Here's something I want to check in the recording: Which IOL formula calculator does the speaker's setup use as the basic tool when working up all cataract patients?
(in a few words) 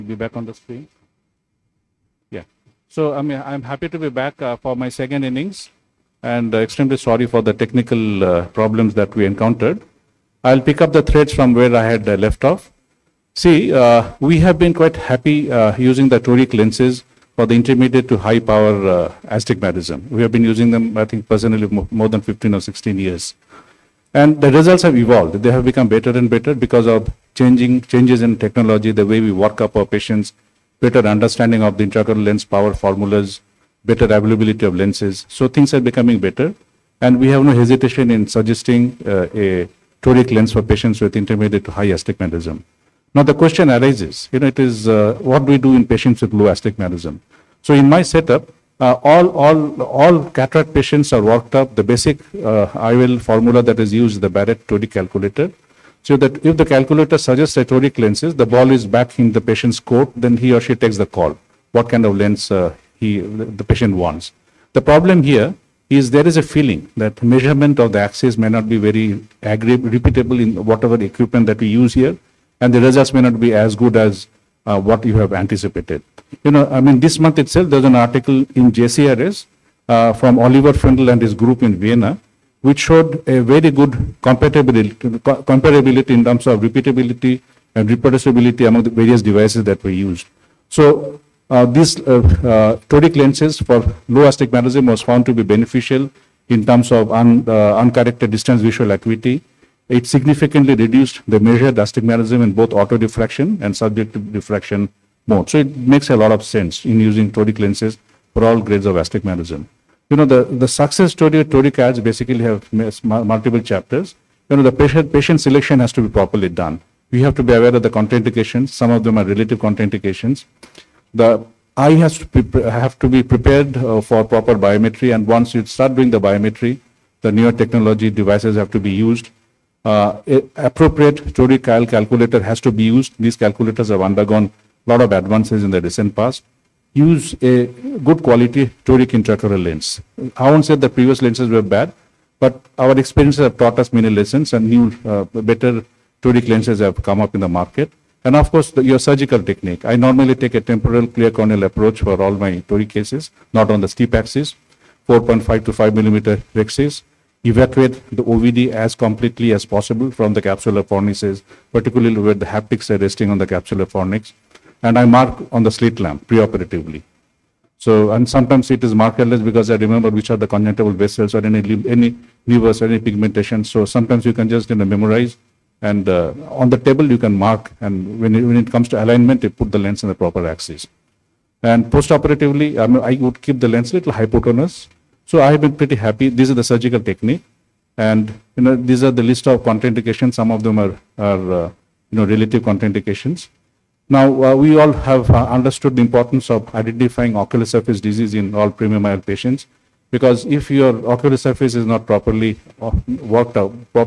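Barrett 2D calculator.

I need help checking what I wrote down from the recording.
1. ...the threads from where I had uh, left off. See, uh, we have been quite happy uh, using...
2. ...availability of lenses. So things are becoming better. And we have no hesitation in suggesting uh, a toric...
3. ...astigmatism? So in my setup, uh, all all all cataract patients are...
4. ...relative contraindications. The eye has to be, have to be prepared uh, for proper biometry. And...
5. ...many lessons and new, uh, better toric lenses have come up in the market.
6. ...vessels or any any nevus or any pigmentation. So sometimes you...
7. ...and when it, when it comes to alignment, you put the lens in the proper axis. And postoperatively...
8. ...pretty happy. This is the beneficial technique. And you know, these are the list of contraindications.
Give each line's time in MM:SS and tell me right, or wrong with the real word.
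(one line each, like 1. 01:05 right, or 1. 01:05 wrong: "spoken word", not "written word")
1. 00:10 right
2. 00:34 right
3. 00:46 right
4. 01:59 right
5. 02:23 right
6. 02:50 right
7. 02:57 right
8. 03:05 wrong: "surgical", not "beneficial".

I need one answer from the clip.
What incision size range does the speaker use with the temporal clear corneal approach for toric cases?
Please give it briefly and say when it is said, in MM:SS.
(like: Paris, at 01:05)
4.5 to 5 millimeters, at 02:35.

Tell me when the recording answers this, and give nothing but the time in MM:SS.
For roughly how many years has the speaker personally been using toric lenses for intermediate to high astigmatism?
00:22.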